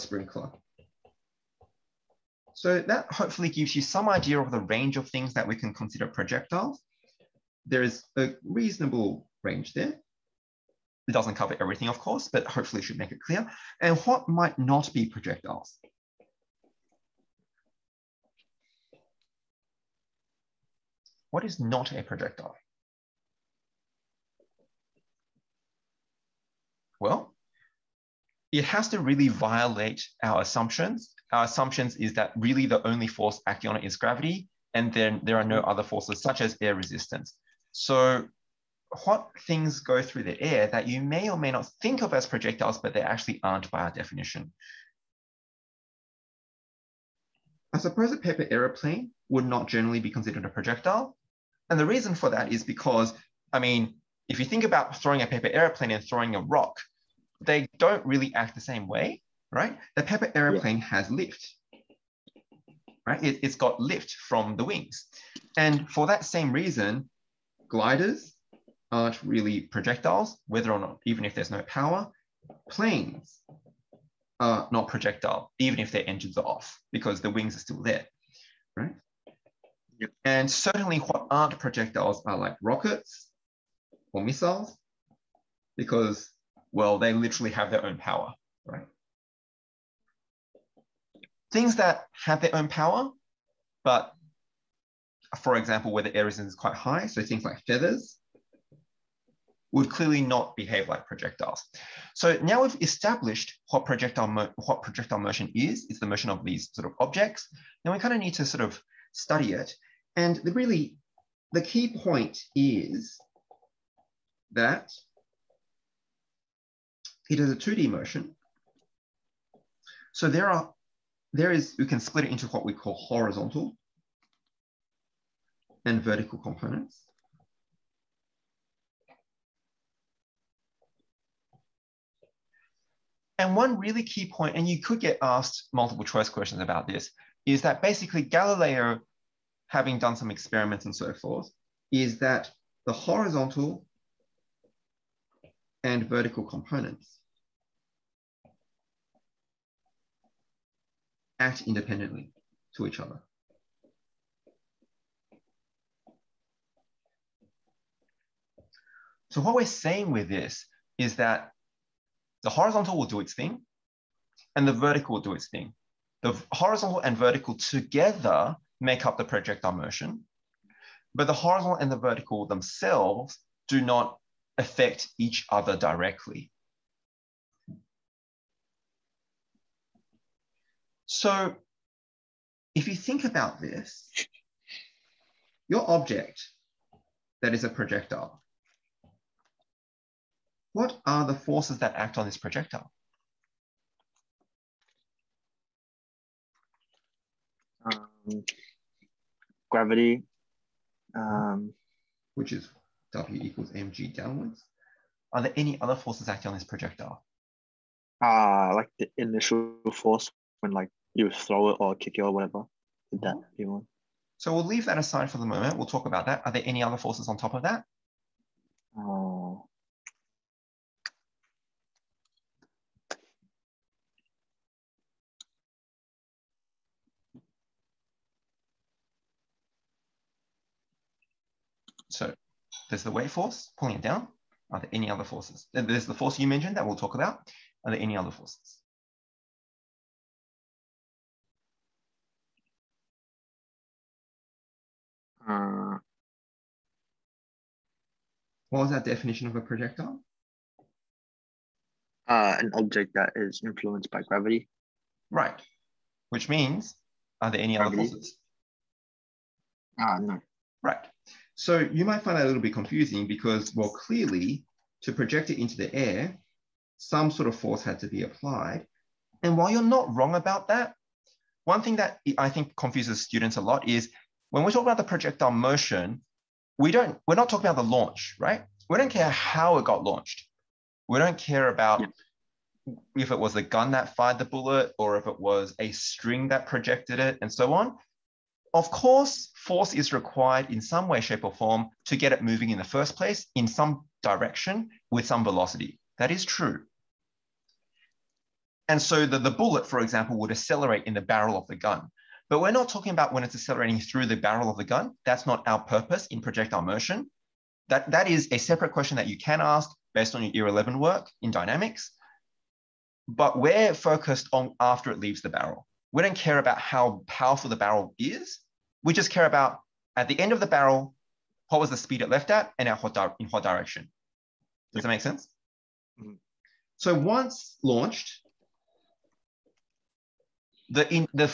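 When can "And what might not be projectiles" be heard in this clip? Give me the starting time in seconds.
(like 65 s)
13 s.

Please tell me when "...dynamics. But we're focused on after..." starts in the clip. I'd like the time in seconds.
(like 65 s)
311 s.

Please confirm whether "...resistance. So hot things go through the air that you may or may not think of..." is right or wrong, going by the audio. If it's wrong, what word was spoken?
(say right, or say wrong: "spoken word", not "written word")
right.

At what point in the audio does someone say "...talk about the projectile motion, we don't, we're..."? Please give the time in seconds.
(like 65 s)
274 s.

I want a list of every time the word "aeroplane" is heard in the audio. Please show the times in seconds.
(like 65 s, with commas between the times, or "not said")
48 s, 55 s, 60 s.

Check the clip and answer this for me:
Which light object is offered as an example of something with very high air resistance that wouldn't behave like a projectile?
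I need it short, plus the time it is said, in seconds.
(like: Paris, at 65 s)
Feathers, at 97 s.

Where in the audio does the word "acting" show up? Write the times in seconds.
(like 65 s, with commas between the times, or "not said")
33 s, 206 s.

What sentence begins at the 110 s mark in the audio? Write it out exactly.
And the really, the key point is that it is a 2D motion.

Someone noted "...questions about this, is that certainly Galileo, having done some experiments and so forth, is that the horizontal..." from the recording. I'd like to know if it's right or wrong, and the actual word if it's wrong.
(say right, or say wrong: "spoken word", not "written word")
wrong: "basically", not "certainly".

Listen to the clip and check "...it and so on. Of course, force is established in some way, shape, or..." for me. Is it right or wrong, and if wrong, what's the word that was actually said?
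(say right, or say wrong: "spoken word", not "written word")
wrong: "required", not "established".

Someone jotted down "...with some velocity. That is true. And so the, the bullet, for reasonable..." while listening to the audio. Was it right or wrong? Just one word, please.
wrong.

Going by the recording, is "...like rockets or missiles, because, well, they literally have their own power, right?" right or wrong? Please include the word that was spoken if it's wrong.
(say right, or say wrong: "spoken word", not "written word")
right.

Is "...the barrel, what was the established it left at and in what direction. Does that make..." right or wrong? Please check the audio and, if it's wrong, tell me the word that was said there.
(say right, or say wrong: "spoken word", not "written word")
wrong: "speed", not "established".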